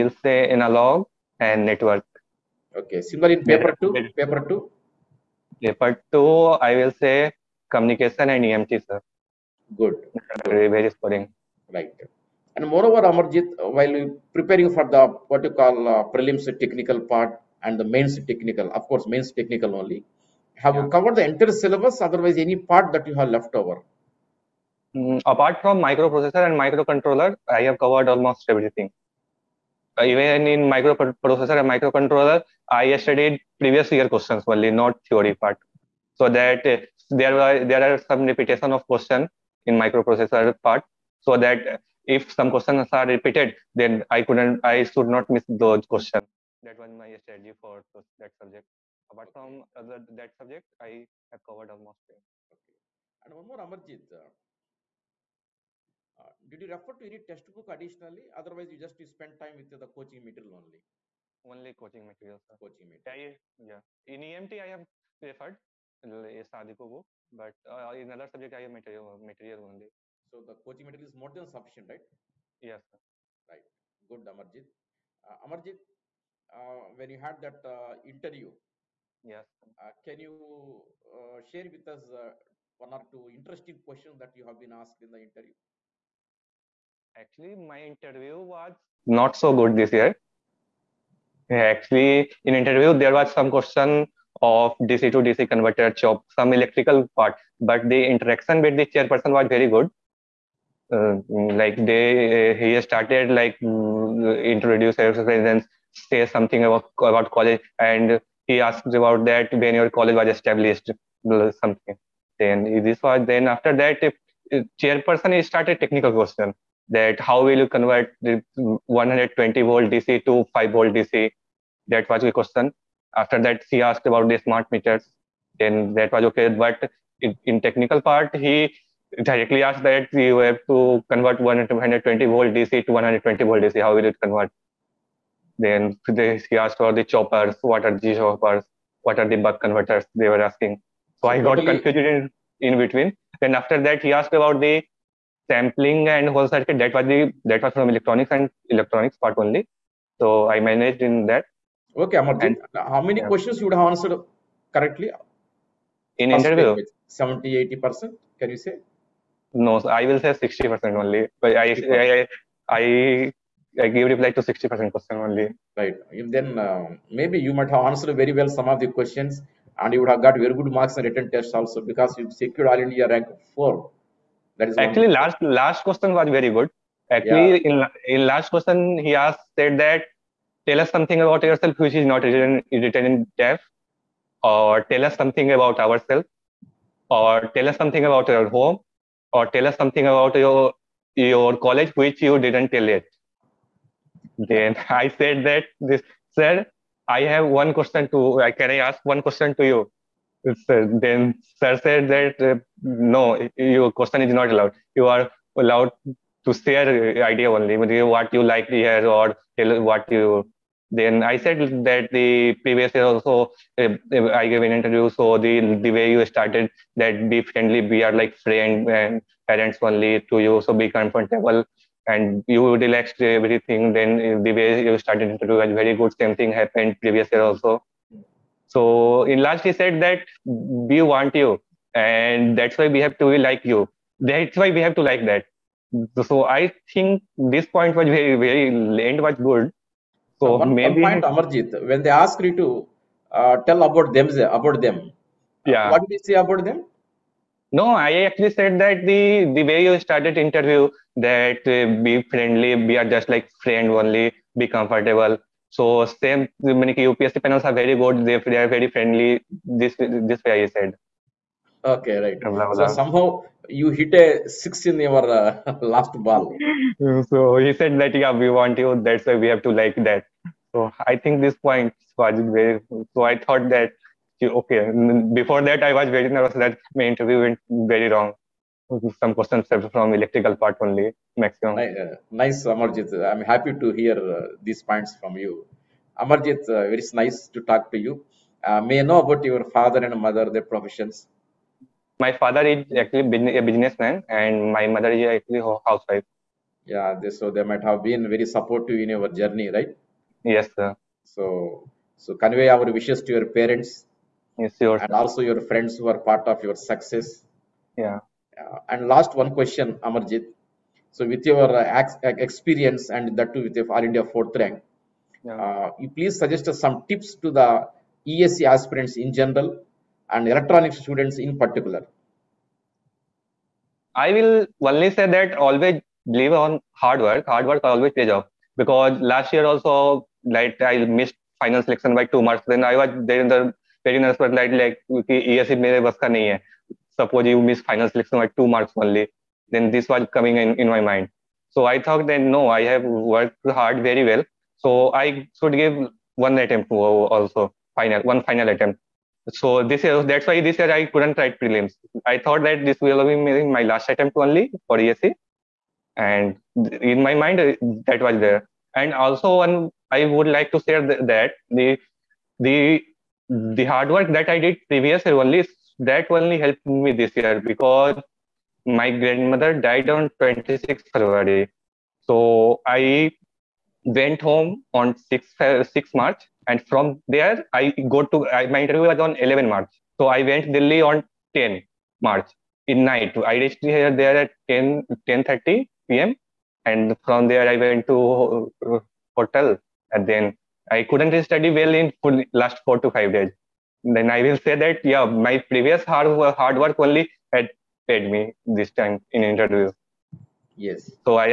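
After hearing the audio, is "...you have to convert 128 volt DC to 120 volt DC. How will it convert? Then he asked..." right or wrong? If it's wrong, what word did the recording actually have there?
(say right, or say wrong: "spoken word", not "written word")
wrong: "120", not "128".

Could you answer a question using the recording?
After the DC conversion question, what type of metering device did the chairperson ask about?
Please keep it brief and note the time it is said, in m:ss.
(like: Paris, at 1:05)
smart meters, at 2:04.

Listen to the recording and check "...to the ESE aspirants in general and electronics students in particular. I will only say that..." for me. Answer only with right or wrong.
right.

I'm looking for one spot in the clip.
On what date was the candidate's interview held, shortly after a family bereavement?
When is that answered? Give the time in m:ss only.
6:19.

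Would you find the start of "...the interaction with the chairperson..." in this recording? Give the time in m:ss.
1:37.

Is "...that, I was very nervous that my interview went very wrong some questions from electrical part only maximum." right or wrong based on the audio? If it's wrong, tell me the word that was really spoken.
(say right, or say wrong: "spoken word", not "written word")
right.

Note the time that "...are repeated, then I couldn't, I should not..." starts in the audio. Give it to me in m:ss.
0:42.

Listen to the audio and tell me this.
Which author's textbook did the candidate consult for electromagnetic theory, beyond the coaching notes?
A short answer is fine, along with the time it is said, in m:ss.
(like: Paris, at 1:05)
Sadiku, at 1:06.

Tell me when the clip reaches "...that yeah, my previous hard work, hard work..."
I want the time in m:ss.
6:34.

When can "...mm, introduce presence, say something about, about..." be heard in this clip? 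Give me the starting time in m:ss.
1:43.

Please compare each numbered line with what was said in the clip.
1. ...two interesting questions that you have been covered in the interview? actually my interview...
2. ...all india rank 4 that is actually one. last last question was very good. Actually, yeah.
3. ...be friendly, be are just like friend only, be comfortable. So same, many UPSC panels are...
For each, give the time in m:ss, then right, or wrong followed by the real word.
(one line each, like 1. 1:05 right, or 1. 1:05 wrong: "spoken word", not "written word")
1. 1:23 wrong: "asked", not "covered"
2. 2:52 right
3. 4:12 right.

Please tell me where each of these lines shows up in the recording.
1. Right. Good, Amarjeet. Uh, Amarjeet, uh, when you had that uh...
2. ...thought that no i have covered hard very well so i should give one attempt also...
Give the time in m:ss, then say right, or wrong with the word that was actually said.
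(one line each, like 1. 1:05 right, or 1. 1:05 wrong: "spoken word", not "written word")
1. 1:13 right
2. 5:42 wrong: "worked", not "covered".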